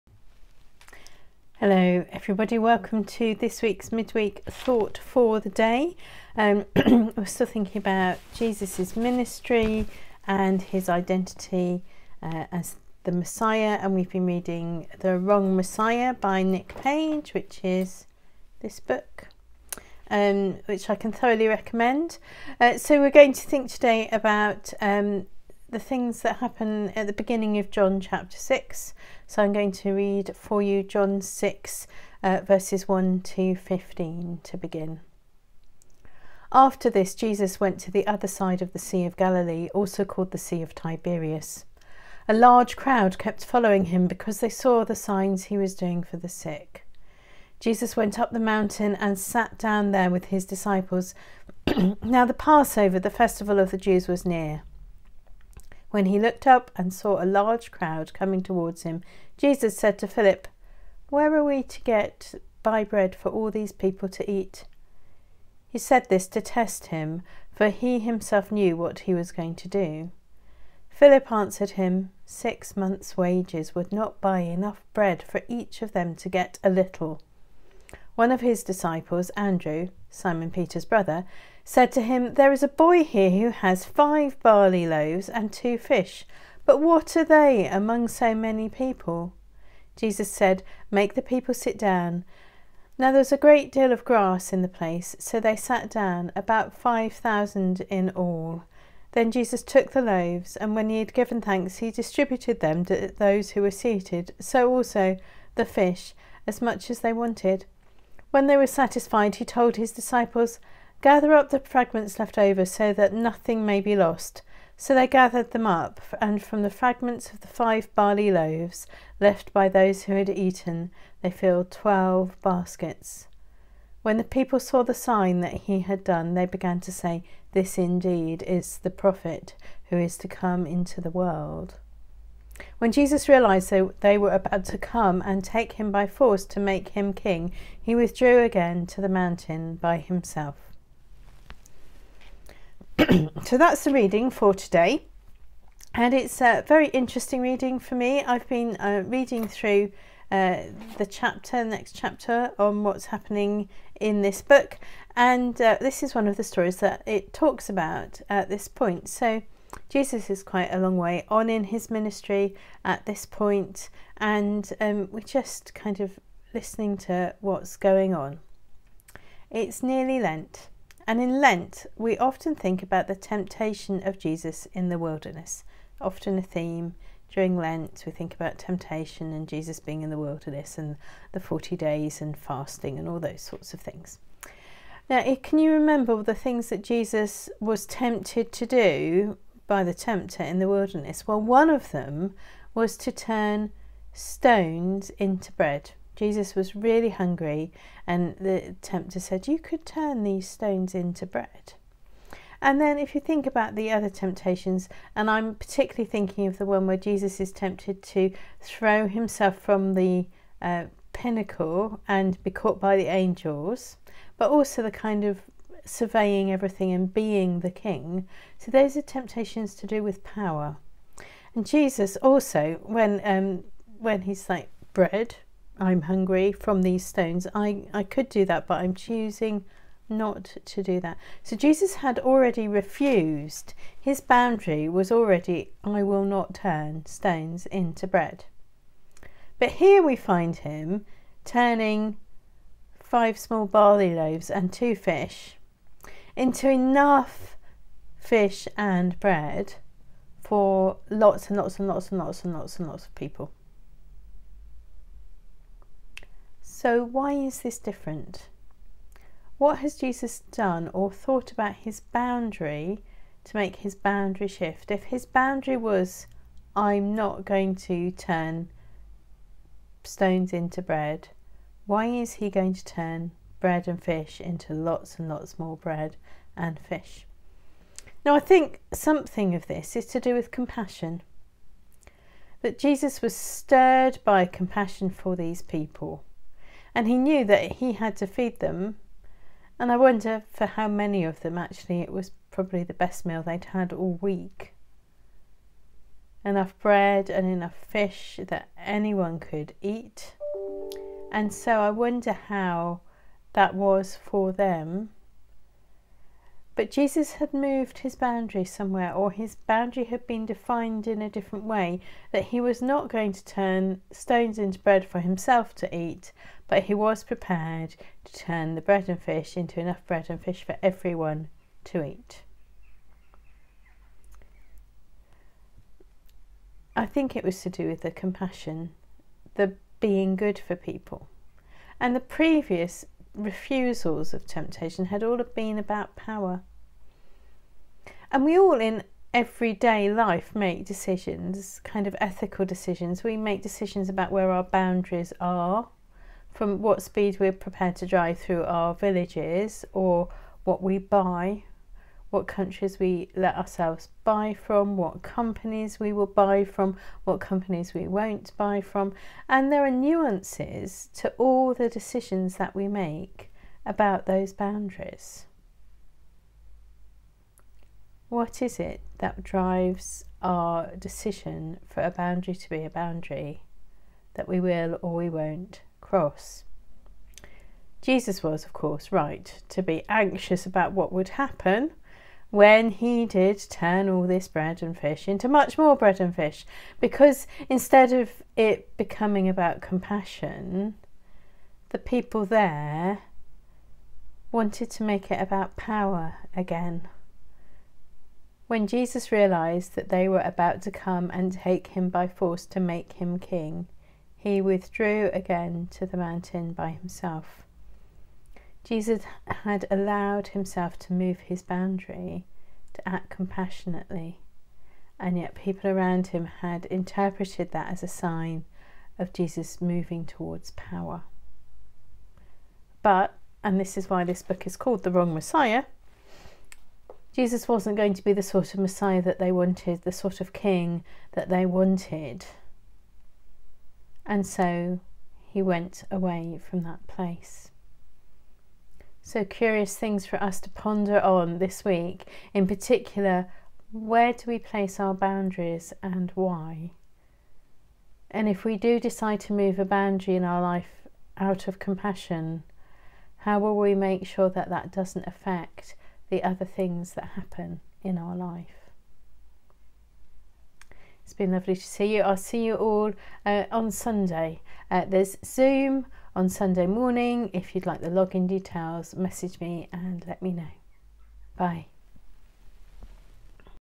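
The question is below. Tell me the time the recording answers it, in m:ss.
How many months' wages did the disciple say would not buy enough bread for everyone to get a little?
1:12.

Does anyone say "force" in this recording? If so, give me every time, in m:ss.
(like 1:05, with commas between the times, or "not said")
2:16, 6:42.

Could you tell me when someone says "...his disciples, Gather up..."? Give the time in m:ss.
1:49.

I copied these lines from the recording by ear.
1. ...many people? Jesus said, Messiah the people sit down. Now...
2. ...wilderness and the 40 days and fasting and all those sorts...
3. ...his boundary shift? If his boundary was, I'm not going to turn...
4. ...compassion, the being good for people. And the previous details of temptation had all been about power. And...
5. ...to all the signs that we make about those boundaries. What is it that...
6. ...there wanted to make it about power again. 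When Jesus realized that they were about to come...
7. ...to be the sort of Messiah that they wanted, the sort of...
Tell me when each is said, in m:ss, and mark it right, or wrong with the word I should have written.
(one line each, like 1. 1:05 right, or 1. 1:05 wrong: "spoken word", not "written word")
1. 1:28 wrong: "Make", not "Messiah"
2. 3:00 right
3. 4:23 right
4. 5:28 wrong: "refusals", not "details"
5. 6:01 wrong: "decisions", not "signs"
6. 6:32 right
7. 7:08 right.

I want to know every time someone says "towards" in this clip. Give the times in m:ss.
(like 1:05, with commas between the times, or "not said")
0:58, 7:00.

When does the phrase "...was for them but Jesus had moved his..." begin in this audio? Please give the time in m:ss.
5:03.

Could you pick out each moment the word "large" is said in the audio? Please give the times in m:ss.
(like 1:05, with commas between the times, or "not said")
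0:42, 0:57.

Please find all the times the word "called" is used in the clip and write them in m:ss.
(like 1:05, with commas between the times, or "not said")
0:40, 7:04.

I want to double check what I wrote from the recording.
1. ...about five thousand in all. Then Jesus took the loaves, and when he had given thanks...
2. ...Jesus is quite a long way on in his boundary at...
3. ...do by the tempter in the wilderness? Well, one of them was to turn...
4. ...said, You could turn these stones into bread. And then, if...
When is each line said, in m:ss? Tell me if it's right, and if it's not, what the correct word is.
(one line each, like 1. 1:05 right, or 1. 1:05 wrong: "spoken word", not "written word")
1. 1:36 right
2. 2:39 wrong: "ministry", not "boundary"
3. 3:08 right
4. 3:19 right.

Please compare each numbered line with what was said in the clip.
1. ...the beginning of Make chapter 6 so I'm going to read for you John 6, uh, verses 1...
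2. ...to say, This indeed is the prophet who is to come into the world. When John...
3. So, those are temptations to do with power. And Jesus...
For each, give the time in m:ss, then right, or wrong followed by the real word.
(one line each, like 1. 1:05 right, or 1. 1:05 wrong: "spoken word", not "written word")
1. 0:27 wrong: "John", not "Make"
2. 2:06 wrong: "Jesus", not "John"
3. 3:38 right.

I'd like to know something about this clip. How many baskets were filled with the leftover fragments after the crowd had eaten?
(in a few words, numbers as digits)
12.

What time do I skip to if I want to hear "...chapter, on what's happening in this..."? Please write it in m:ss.
2:31.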